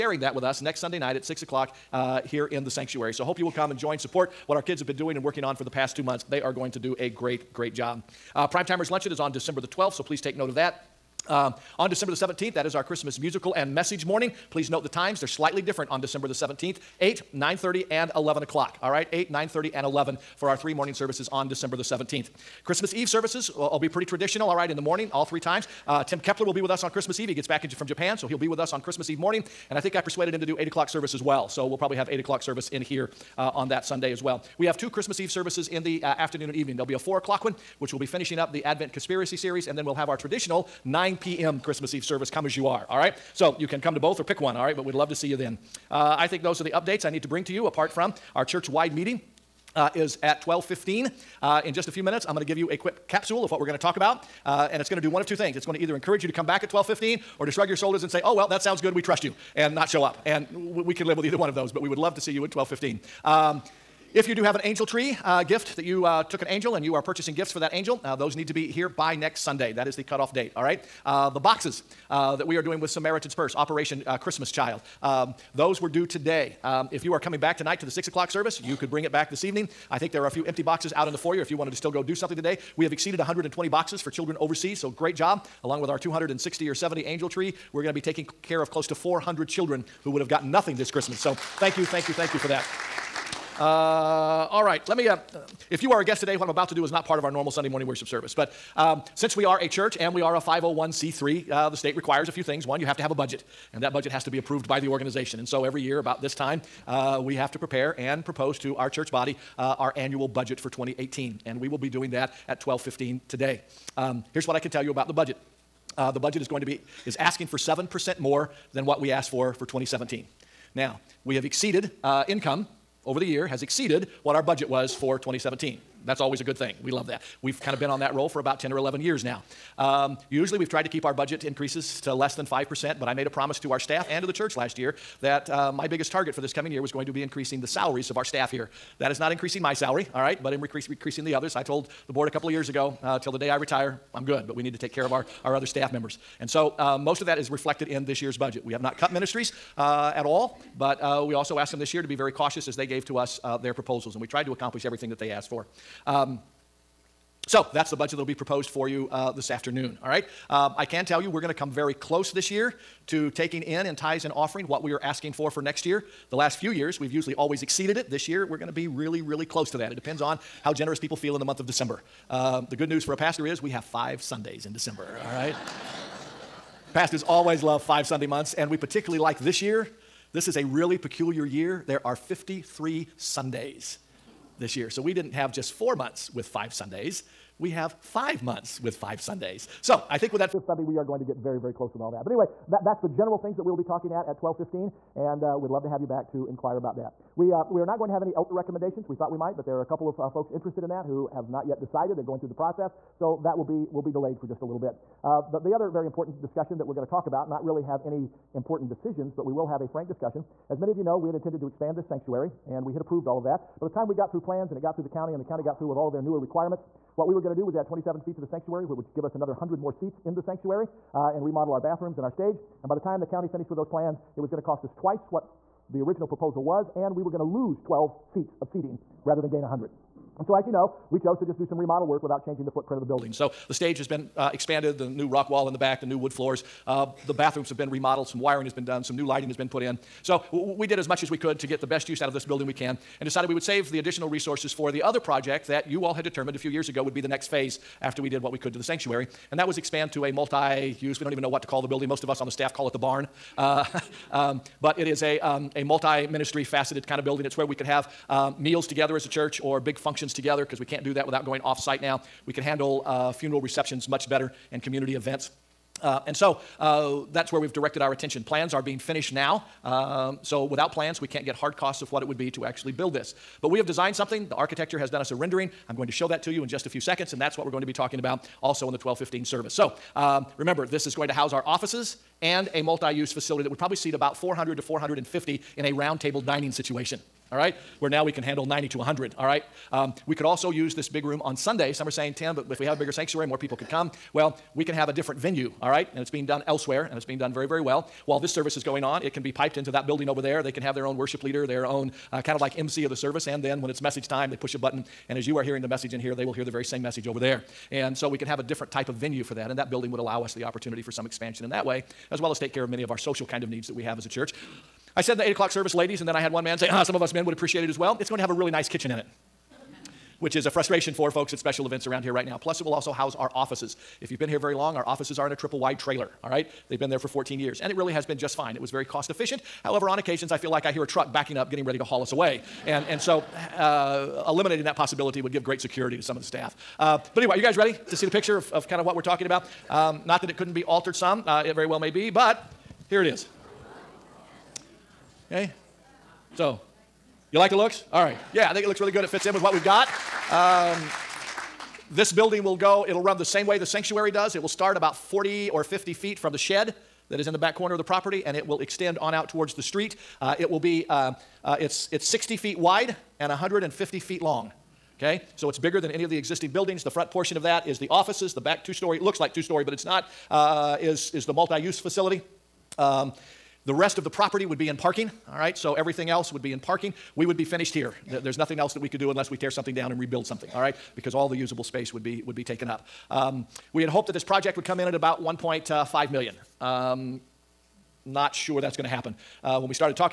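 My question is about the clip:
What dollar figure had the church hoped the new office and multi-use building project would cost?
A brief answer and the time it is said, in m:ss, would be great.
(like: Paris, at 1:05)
1.5 million, at 6:25.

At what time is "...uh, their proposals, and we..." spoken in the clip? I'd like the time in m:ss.
2:33.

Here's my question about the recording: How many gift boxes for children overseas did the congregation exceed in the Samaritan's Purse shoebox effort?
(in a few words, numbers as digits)
120.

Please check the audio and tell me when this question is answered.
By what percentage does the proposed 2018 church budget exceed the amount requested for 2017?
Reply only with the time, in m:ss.
1:57.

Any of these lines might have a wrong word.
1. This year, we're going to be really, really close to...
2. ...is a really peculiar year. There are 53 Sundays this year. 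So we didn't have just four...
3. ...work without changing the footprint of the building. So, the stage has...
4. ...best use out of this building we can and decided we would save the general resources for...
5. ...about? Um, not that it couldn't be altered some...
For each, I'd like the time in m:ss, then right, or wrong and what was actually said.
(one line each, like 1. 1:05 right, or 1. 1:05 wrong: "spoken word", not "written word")
1. 2:48 right
2. 3:00 right
3. 3:52 right
4. 4:01 wrong: "additional", not "general"
5. 5:39 right.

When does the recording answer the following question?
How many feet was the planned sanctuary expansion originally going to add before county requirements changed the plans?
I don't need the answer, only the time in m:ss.
3:37.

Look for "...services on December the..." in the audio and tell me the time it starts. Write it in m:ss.
0:20.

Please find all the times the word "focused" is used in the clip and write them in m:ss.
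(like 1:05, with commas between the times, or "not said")
not said.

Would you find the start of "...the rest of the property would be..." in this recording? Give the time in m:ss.
6:13.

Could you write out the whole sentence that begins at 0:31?
So we'll probably have 8 o'clock service in here uh, on that Sunday as well.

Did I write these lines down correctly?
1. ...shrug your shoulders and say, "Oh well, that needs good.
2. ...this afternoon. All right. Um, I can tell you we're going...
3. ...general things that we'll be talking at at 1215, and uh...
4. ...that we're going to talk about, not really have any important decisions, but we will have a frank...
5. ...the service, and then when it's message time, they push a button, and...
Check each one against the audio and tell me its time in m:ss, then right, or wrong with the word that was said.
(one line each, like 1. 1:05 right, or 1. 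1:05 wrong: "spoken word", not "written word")
1. 0:57 wrong: "sounds", not "needs"
2. 2:39 right
3. 3:13 right
4. 3:26 right
5. 5:03 right.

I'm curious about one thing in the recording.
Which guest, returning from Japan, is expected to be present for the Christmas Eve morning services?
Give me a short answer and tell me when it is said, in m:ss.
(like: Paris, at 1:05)
Tim Kepler, at 0:26.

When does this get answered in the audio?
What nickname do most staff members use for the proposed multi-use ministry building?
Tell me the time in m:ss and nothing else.
4:12.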